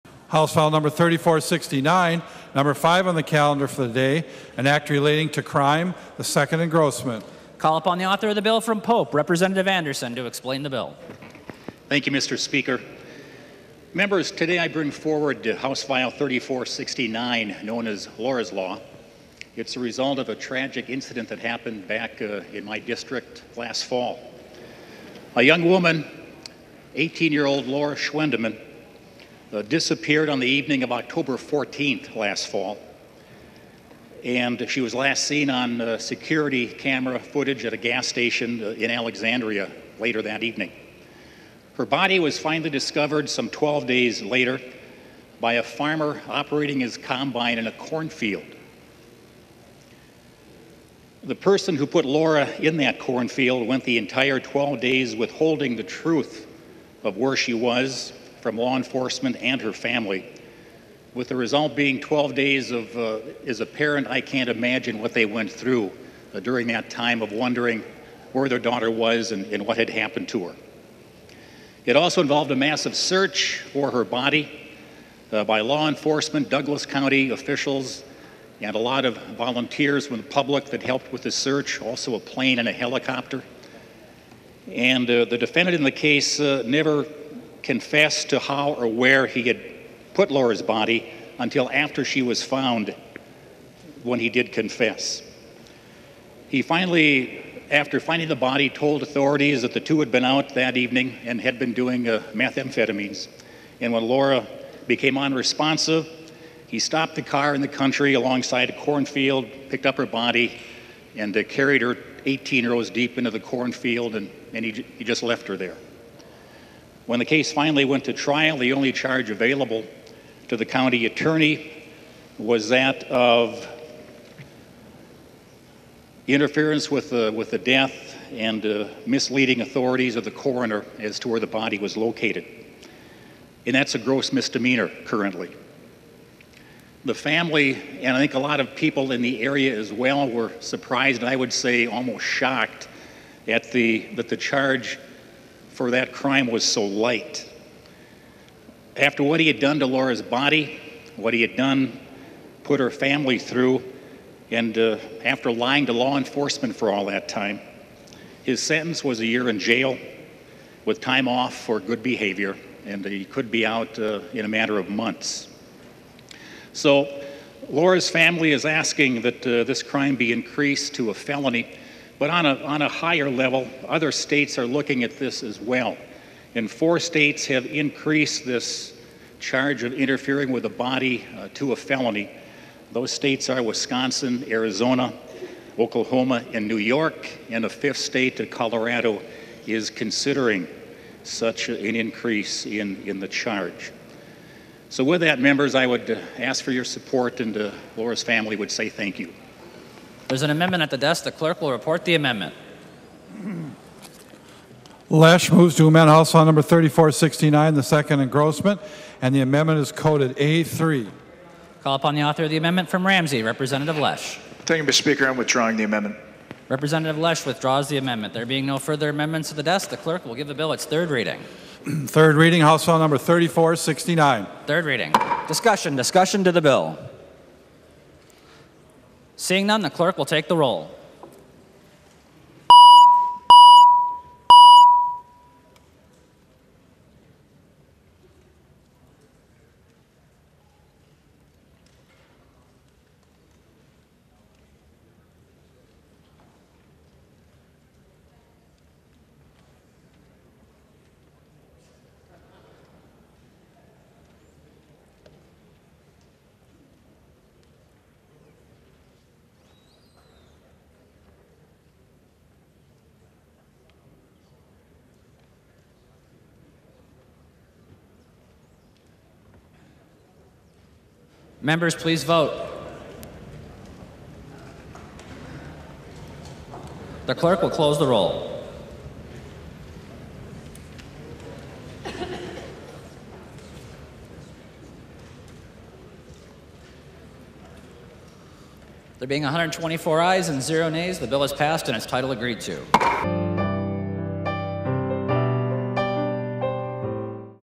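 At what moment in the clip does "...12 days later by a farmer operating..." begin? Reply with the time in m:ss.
0:43.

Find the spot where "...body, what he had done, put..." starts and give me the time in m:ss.
2:30.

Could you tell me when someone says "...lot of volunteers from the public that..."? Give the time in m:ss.
1:18.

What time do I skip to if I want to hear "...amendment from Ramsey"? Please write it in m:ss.
3:32.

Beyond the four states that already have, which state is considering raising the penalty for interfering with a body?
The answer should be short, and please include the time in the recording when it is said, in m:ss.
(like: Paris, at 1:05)
Colorado, at 3:08.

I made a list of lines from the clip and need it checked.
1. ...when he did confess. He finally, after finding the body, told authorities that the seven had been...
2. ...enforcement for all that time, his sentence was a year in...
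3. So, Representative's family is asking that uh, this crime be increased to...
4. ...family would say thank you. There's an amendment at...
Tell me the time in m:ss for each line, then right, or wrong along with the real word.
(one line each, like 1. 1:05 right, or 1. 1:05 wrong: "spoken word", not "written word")
1. 1:34 wrong: "two", not "seven"
2. 2:36 right
3. 2:46 wrong: "Laura", not "Representative"
4. 3:18 right.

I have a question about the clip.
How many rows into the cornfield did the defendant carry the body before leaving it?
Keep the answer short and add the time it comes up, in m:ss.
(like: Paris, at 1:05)
18, at 1:52.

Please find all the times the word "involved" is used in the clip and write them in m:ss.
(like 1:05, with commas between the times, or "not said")
1:12.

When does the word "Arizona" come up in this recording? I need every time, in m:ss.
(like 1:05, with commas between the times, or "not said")
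3:04.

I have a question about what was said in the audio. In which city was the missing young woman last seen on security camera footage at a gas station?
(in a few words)
Alexandria.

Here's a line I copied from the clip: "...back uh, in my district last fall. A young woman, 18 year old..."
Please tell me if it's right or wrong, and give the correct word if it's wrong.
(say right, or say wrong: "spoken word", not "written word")
right.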